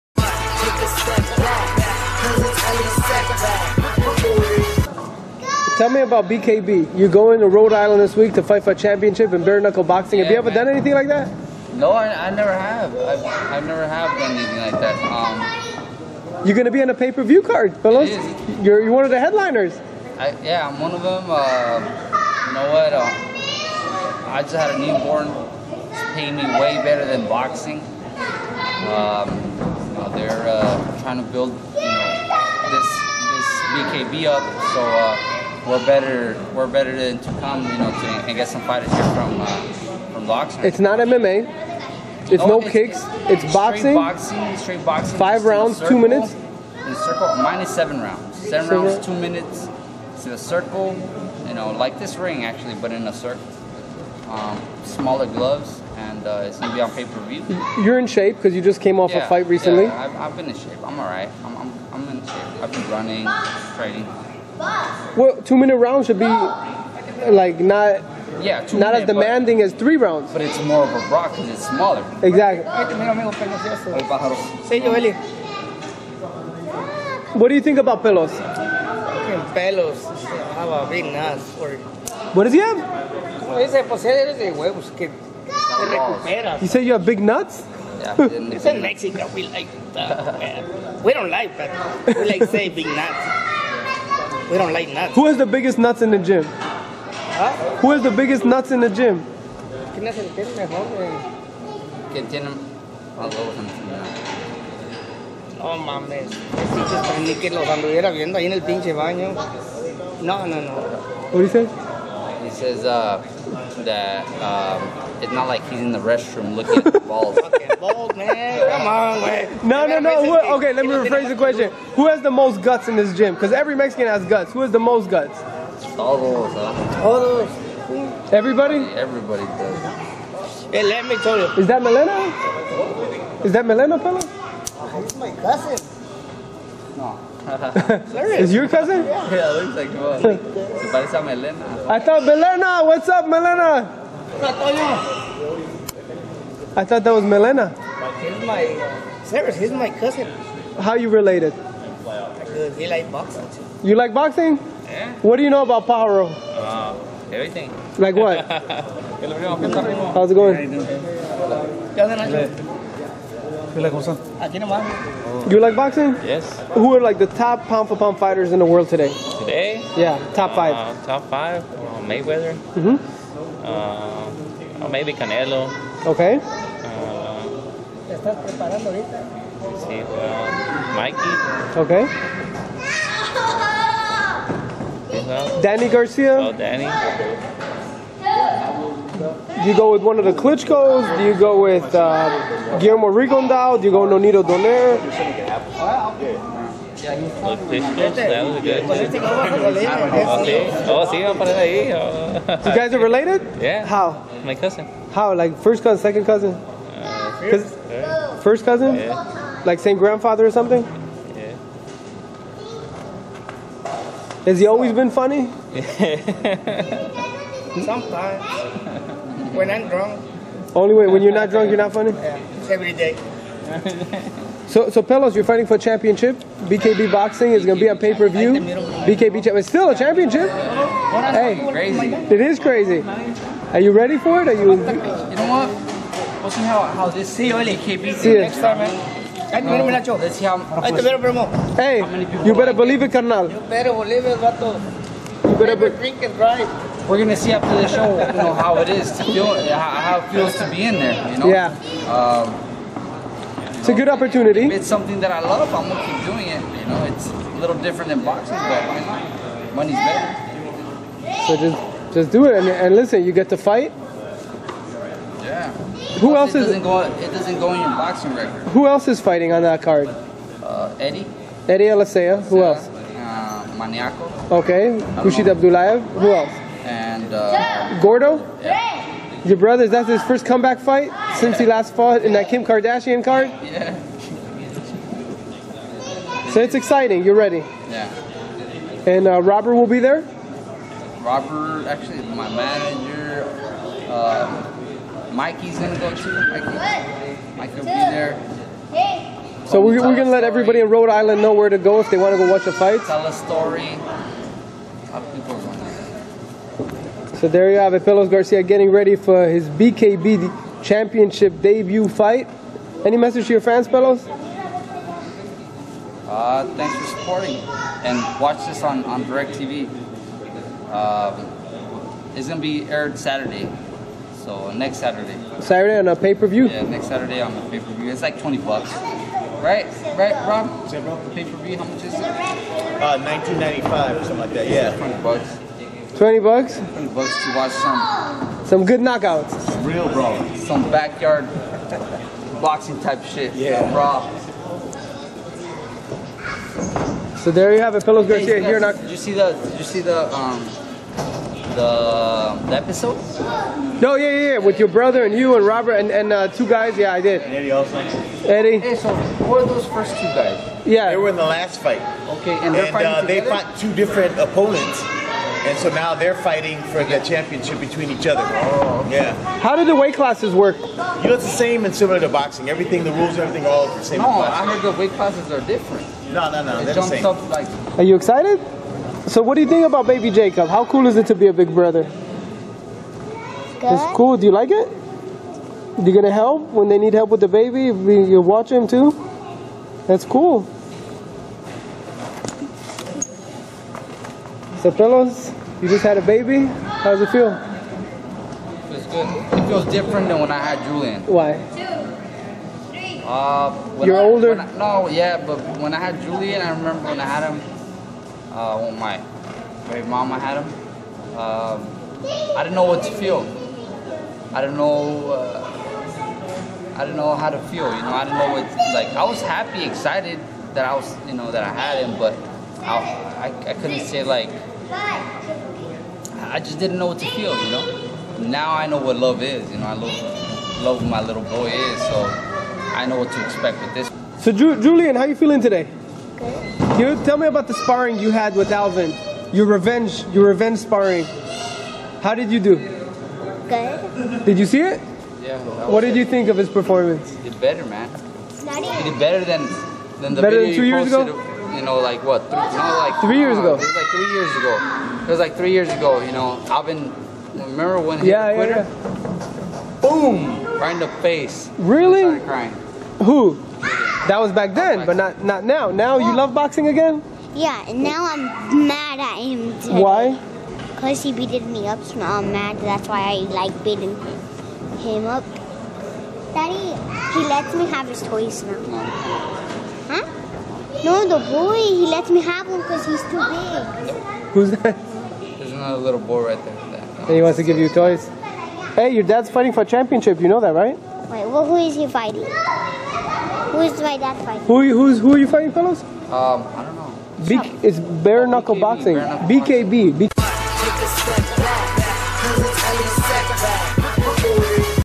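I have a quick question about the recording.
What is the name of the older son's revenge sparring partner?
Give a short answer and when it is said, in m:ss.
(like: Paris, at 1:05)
Alvin, at 7:18.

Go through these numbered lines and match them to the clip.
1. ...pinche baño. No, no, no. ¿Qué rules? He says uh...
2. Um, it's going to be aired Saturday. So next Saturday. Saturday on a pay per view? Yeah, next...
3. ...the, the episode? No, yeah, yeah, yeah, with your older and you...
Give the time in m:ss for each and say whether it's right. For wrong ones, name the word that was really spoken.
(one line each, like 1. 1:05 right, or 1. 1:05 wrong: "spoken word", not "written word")
1. 1:48 wrong: "dices", not "rules"
2. 5:20 right
3. 5:51 wrong: "brother", not "older".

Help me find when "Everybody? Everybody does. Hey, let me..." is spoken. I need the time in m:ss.
2:08.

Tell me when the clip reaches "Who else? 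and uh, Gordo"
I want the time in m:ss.
4:36.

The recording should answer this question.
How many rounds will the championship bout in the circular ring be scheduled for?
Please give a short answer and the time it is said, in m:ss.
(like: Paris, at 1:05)
7, at 0:48.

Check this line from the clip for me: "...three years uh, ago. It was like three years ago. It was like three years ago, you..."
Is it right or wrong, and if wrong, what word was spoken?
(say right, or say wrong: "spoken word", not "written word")
right.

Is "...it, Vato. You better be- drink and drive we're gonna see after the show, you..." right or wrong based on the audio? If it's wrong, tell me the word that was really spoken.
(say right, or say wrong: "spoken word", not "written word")
right.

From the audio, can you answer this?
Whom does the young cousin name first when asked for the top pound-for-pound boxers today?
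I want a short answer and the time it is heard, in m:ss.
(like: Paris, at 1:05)
Mayweather, at 2:52.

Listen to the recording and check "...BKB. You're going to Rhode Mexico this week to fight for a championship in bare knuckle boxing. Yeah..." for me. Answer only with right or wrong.
wrong.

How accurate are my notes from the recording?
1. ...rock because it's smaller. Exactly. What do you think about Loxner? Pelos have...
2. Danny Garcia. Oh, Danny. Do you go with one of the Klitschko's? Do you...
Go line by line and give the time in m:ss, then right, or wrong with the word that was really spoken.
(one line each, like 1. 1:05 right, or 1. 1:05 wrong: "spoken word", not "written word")
1. 1:11 wrong: "Pelos", not "Loxner"
2. 3:05 right.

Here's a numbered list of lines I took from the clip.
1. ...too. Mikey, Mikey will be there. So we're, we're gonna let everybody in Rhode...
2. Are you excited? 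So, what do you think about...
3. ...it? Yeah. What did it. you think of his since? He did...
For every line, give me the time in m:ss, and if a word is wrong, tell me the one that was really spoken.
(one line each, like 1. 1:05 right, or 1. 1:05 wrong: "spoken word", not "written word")
1. 4:56 right
2. 6:17 right
3. 7:24 wrong: "performance", not "since".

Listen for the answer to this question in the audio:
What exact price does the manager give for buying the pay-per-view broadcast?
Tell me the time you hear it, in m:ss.
5:33.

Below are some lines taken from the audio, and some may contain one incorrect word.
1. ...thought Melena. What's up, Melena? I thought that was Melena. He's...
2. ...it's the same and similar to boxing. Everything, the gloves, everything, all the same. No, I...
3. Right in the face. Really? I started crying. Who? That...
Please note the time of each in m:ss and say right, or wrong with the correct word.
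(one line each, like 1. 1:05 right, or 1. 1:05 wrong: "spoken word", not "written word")
1. 2:21 right
2. 6:11 wrong: "rules", not "gloves"
3. 7:40 right.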